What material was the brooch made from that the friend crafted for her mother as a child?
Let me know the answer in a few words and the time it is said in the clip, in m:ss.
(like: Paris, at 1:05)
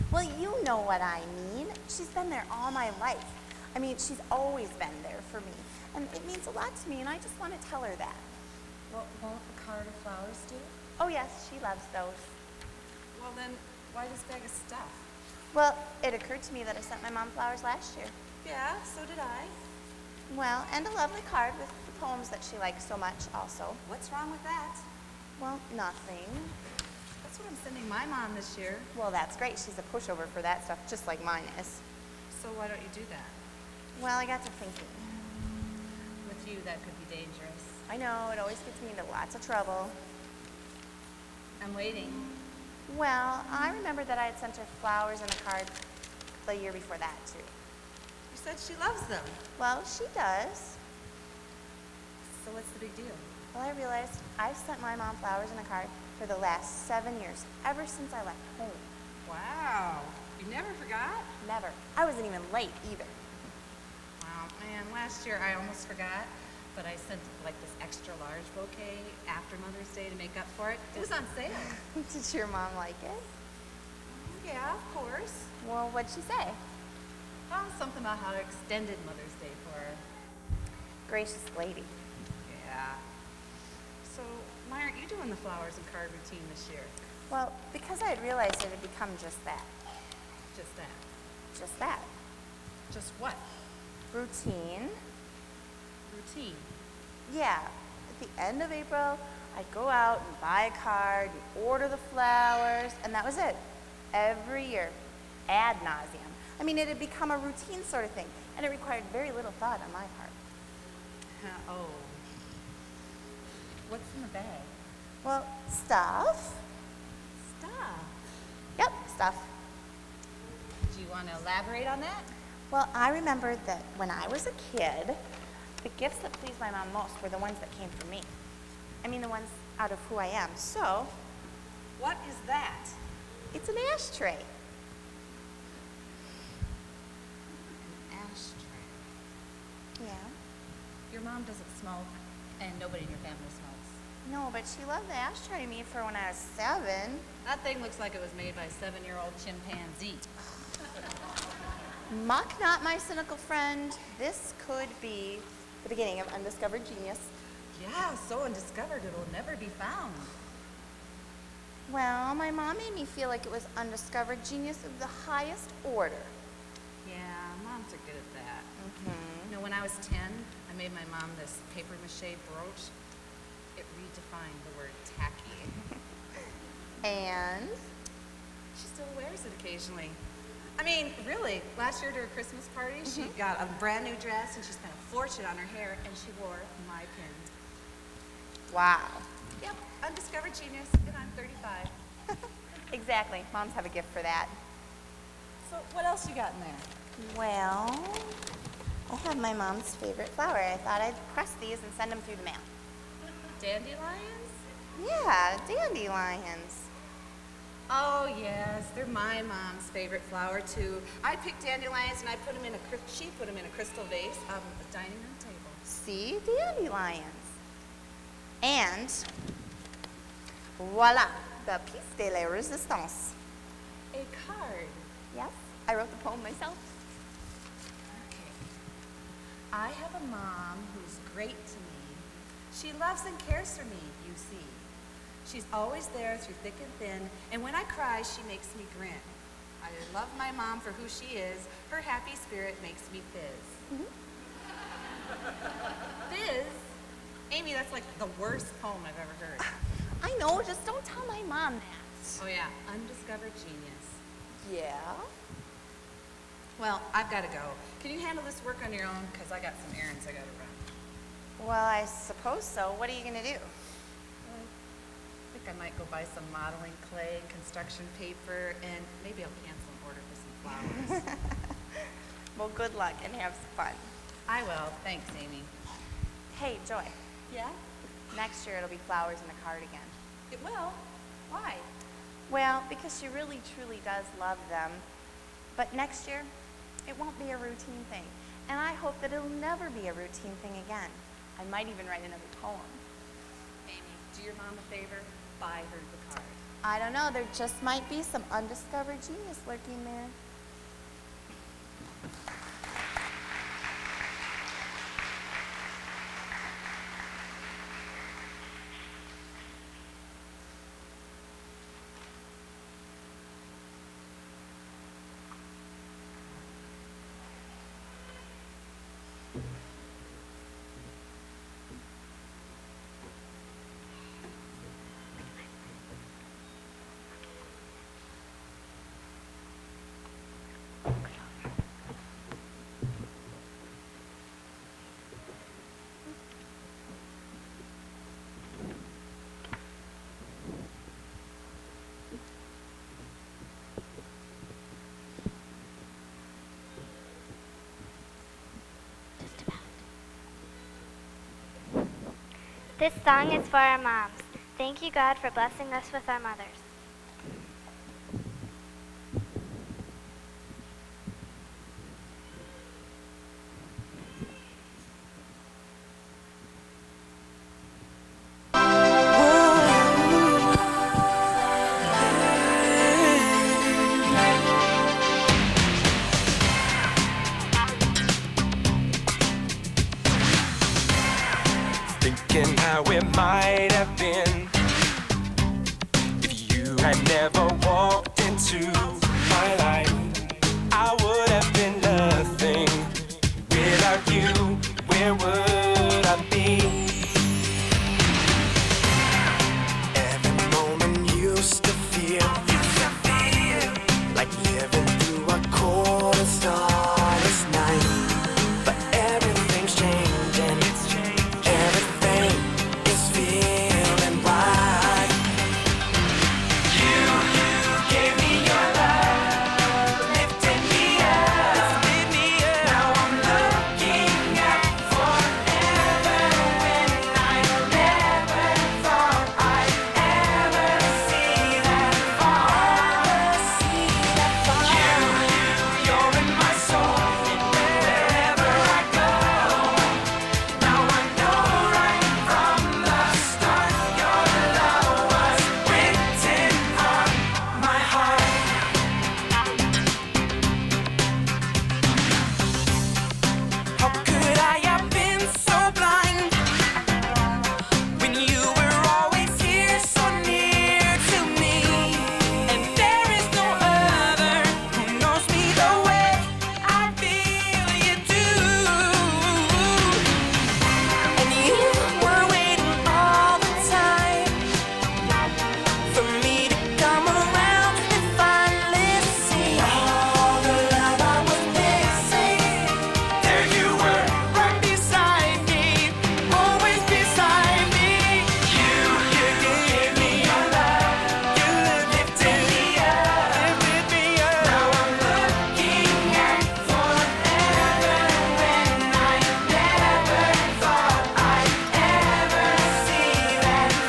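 Paper mache, at 2:51.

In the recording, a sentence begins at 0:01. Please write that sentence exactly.
She's been there all my life.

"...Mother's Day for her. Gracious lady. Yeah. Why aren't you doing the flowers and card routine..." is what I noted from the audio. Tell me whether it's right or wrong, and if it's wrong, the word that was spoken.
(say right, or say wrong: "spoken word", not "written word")
right.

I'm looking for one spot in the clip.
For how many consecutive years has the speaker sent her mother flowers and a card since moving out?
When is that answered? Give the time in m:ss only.
0:56.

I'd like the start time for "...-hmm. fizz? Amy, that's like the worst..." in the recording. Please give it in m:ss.
4:03.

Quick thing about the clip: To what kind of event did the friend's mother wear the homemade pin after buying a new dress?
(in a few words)
Christmas party.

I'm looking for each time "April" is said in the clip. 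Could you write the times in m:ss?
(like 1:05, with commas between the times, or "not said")
1:38.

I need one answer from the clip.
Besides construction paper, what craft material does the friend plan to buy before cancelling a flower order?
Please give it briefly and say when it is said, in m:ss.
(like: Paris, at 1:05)
Modeling clay, at 4:26.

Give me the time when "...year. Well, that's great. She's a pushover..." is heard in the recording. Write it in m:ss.
0:28.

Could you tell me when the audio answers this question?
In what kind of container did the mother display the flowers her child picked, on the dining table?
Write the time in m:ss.
3:33.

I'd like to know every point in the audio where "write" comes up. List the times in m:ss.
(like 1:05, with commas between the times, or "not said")
4:52.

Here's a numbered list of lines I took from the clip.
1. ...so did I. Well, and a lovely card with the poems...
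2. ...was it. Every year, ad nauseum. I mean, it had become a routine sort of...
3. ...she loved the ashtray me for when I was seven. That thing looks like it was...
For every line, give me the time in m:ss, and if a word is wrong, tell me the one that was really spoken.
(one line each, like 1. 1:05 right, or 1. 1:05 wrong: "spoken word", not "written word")
1. 0:18 right
2. 1:43 right
3. 2:24 right.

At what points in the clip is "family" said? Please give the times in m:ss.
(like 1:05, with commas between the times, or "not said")
2:23.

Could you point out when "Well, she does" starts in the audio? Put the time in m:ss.
0:49.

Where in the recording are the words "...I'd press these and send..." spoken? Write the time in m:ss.
3:21.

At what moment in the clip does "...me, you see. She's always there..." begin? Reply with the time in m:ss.
3:53.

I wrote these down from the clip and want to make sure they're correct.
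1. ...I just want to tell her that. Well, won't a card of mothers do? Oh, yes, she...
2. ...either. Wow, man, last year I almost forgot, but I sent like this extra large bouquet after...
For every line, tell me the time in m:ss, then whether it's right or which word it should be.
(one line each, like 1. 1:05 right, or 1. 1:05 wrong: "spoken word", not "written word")
1. 0:07 wrong: "flowers", not "mothers"
2. 1:02 right.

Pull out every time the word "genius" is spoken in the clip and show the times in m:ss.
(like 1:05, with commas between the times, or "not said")
2:36, 2:44, 3:10, 4:13, 4:59.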